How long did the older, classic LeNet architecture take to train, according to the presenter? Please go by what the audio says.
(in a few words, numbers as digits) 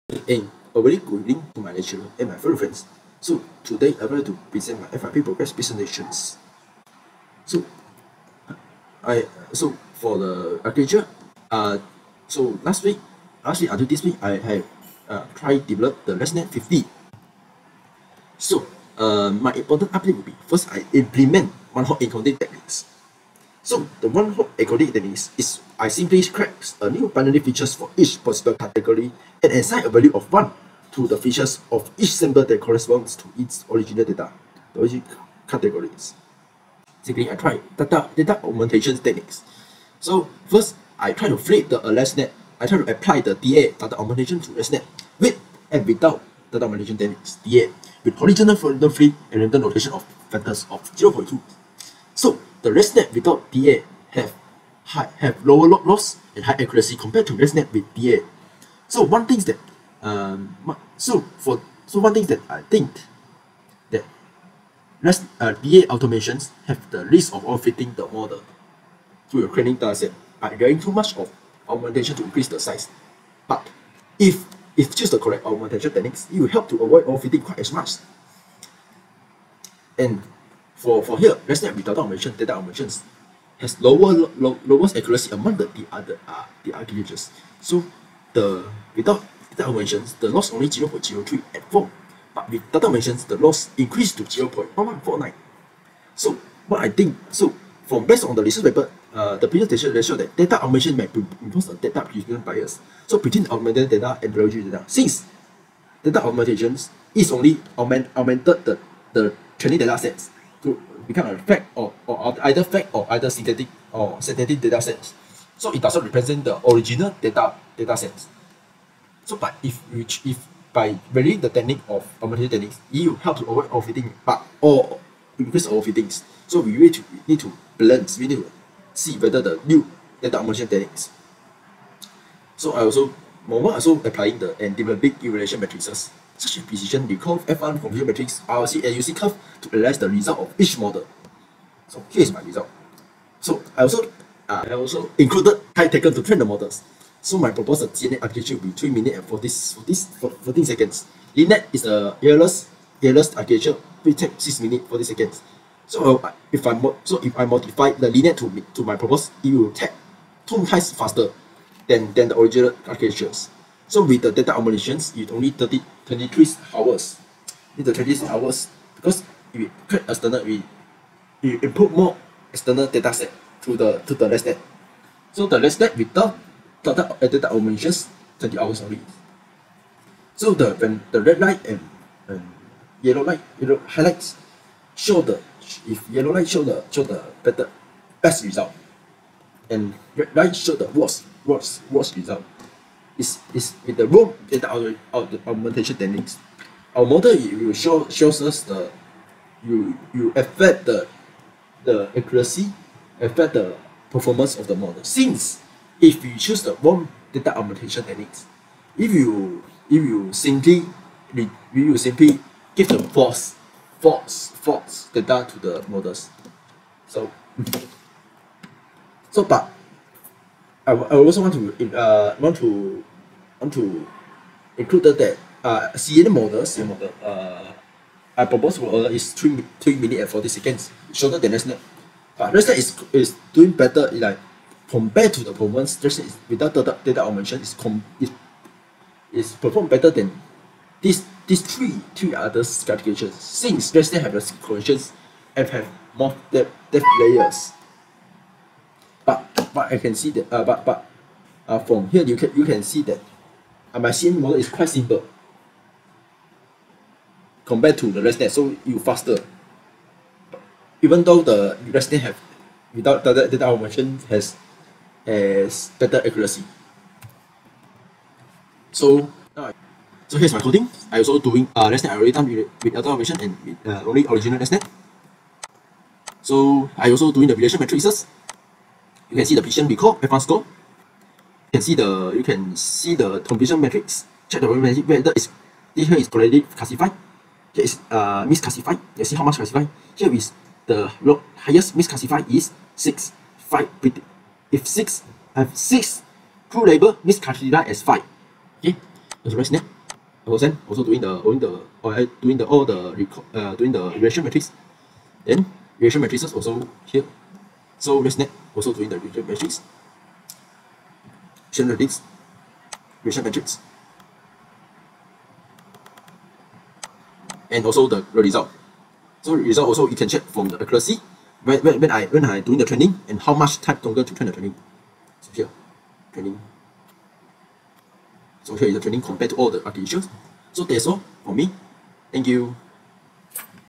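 6 minutes 40 seconds.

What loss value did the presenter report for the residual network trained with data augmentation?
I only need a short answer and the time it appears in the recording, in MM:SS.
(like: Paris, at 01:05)
0.1149, at 01:34.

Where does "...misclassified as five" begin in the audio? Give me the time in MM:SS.
04:57.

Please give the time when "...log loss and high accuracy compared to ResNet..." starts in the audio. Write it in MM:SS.
00:55.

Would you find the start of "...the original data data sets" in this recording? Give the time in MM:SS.
01:56.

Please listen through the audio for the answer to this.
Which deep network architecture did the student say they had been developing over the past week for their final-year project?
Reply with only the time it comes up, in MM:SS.
00:16.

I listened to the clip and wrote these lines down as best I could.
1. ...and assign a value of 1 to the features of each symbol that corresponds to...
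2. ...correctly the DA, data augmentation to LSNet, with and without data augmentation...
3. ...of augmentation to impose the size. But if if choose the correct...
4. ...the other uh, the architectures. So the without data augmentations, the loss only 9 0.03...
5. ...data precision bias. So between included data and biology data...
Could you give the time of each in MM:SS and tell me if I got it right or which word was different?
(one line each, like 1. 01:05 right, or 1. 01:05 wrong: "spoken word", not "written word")
1. 00:29 right
2. 00:42 wrong: "apply", not "correctly"
3. 01:11 wrong: "increase", not "impose"
4. 01:25 wrong: "0", not "9"
5. 01:41 wrong: "augmented", not "included".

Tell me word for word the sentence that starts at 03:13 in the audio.
It's, it's with the wrong data augmentation techniques.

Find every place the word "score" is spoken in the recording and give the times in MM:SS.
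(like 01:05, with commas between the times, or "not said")
04:40.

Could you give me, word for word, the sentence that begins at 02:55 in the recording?
So the ResNet without data uh, data emulations, twenty hours only.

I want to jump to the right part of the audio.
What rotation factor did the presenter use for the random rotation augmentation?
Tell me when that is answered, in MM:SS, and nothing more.
00:50.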